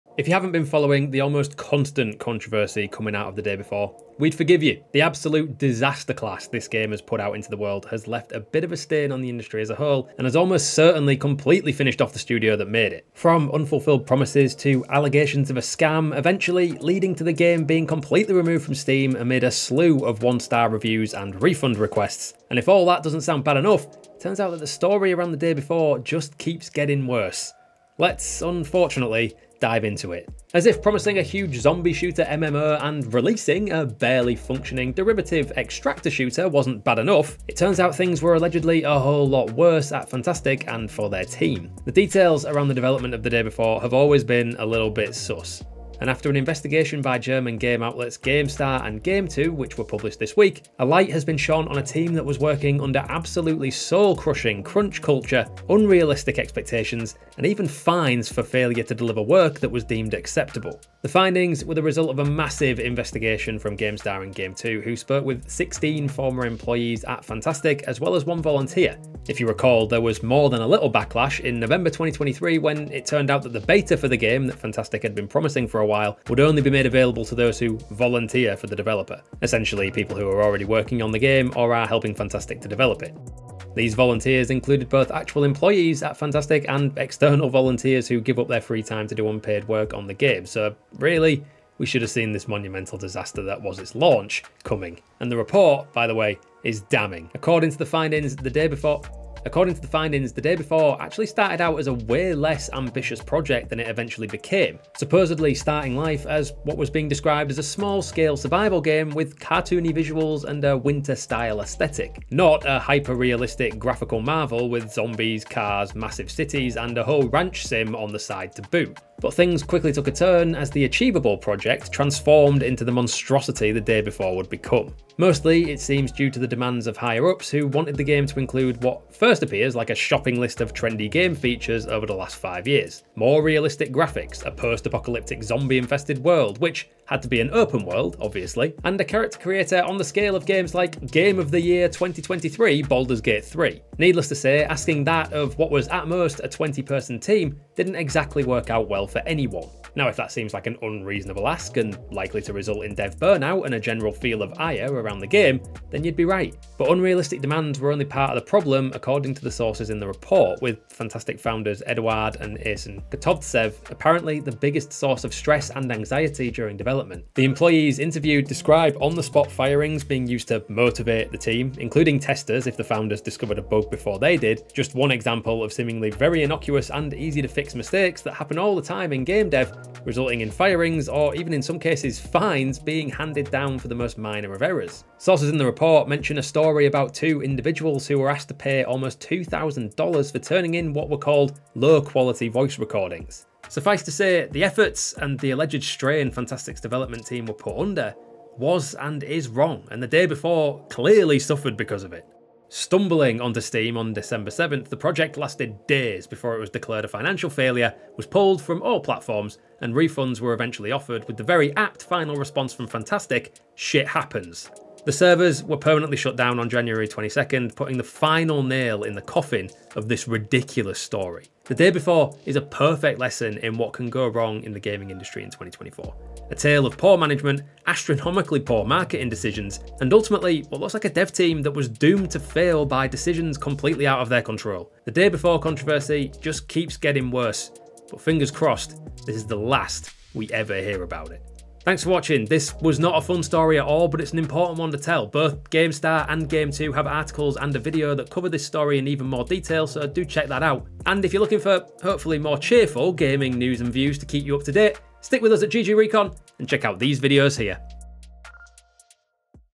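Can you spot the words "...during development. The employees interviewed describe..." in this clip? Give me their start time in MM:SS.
02:46.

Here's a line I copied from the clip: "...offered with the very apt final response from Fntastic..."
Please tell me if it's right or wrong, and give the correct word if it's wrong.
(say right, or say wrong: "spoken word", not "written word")
right.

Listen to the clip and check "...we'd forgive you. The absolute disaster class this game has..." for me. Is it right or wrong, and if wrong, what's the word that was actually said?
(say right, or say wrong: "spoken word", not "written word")
right.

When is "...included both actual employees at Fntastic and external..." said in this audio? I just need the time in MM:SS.
01:24.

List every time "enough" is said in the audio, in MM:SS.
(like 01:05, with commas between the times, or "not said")
00:23, 00:36.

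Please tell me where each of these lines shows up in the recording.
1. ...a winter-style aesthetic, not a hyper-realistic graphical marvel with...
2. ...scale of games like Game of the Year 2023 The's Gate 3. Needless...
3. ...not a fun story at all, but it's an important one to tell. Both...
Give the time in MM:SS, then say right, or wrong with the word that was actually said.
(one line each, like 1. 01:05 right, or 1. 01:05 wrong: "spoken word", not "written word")
1. 01:50 right
2. 02:20 wrong: "Baldur", not "The"
3. 04:02 right.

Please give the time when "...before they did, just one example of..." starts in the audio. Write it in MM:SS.
02:53.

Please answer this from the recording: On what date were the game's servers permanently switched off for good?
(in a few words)
January 22nd.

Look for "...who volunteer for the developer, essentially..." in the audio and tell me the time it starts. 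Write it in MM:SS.
01:17.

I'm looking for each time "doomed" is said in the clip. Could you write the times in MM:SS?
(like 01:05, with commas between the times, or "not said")
03:51.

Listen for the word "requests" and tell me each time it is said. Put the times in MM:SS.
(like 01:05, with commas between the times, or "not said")
00:21.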